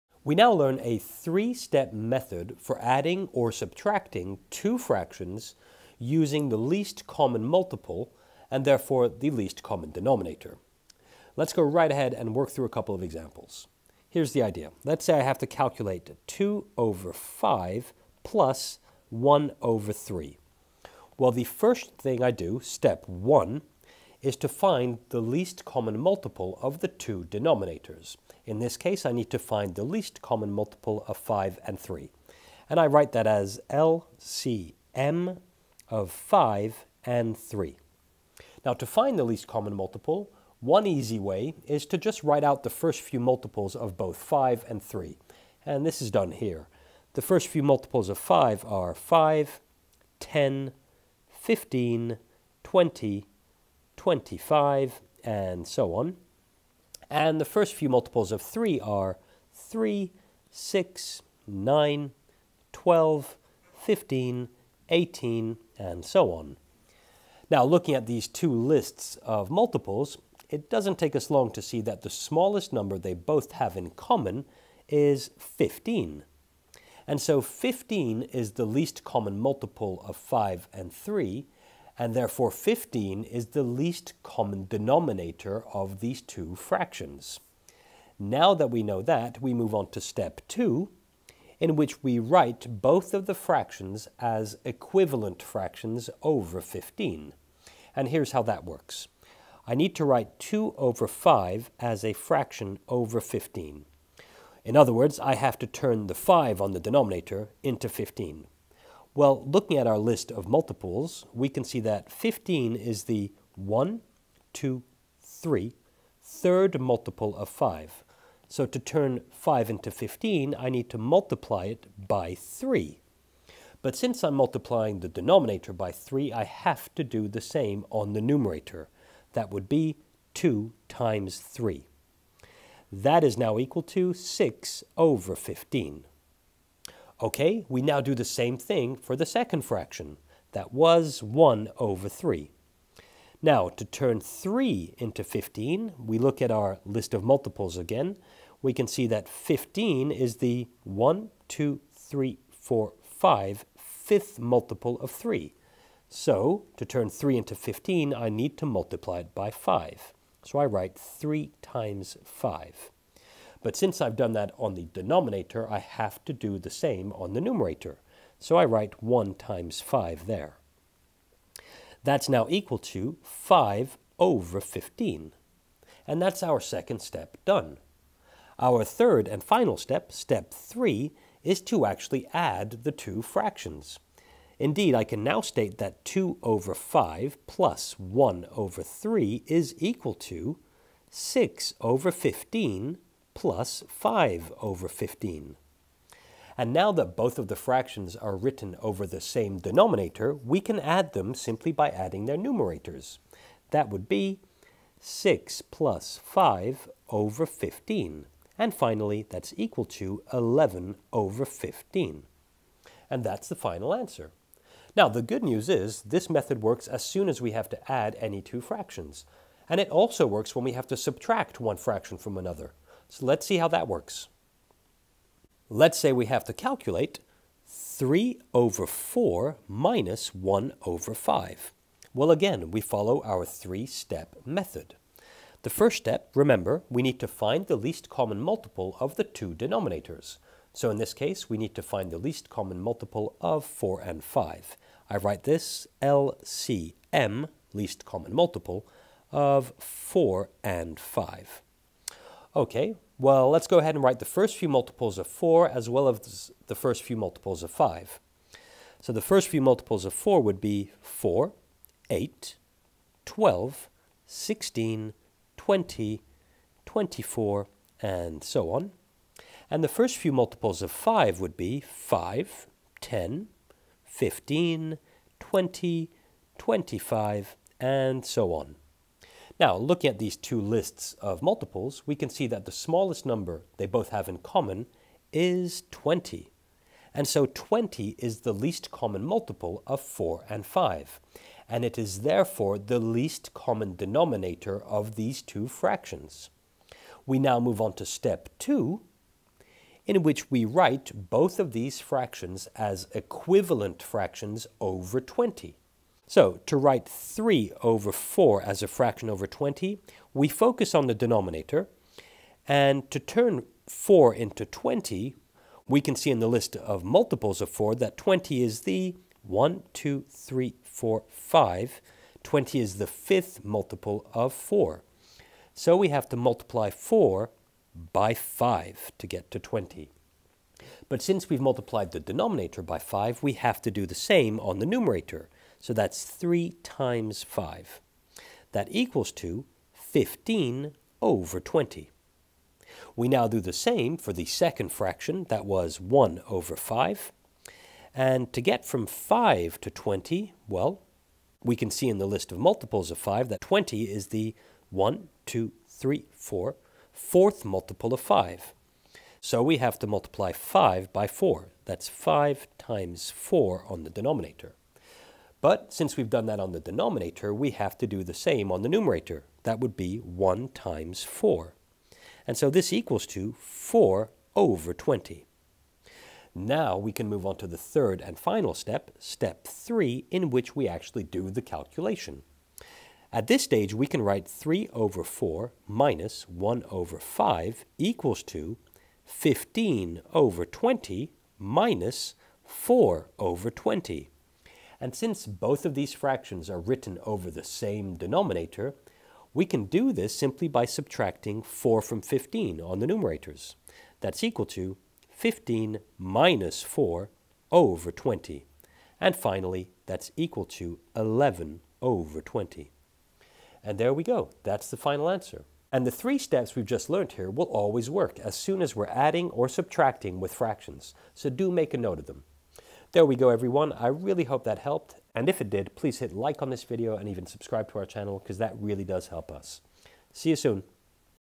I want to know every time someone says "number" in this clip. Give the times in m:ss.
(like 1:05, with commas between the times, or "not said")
1:12, 4:43.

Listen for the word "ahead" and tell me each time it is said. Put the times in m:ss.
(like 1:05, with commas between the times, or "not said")
0:11, 4:13.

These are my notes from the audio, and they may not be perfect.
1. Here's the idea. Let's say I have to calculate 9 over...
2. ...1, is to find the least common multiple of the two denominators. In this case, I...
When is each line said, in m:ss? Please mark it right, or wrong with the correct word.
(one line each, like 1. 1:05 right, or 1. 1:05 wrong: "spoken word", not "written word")
1. 0:14 wrong: "2", not "9"
2. 0:23 right.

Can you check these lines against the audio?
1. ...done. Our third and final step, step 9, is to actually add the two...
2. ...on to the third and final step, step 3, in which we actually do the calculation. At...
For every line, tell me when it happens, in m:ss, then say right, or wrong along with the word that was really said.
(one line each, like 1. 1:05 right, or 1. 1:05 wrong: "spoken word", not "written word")
1. 2:57 wrong: "3", not "9"
2. 6:17 right.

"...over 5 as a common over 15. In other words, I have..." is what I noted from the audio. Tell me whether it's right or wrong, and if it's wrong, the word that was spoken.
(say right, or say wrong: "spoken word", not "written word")
wrong: "fraction", not "common".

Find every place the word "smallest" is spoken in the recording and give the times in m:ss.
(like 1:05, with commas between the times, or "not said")
1:12, 4:42.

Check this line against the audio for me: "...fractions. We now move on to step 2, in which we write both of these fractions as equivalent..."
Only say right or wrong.
right.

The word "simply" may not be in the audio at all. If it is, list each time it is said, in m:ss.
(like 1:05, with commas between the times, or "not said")
3:21, 6:40.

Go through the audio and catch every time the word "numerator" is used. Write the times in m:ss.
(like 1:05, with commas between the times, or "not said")
2:08, 2:47, 3:22, 5:34, 6:08, 6:43.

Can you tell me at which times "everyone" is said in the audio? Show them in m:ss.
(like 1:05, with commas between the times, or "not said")
7:03.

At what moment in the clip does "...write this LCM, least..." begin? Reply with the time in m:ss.
4:05.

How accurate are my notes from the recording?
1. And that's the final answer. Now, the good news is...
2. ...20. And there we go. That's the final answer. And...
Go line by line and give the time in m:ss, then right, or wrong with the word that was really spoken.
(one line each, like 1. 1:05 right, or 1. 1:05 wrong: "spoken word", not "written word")
1. 3:33 right
2. 6:52 right.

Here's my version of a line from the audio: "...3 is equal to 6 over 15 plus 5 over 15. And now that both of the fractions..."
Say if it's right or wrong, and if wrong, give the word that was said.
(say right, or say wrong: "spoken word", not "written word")
right.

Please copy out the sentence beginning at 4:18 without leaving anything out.
So the first few multiples of 4 would be 4, 8, 12, 16, 20, 24, and so on.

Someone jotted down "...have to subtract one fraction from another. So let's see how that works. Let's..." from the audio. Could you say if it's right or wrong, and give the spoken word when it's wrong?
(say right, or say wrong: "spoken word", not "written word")
right.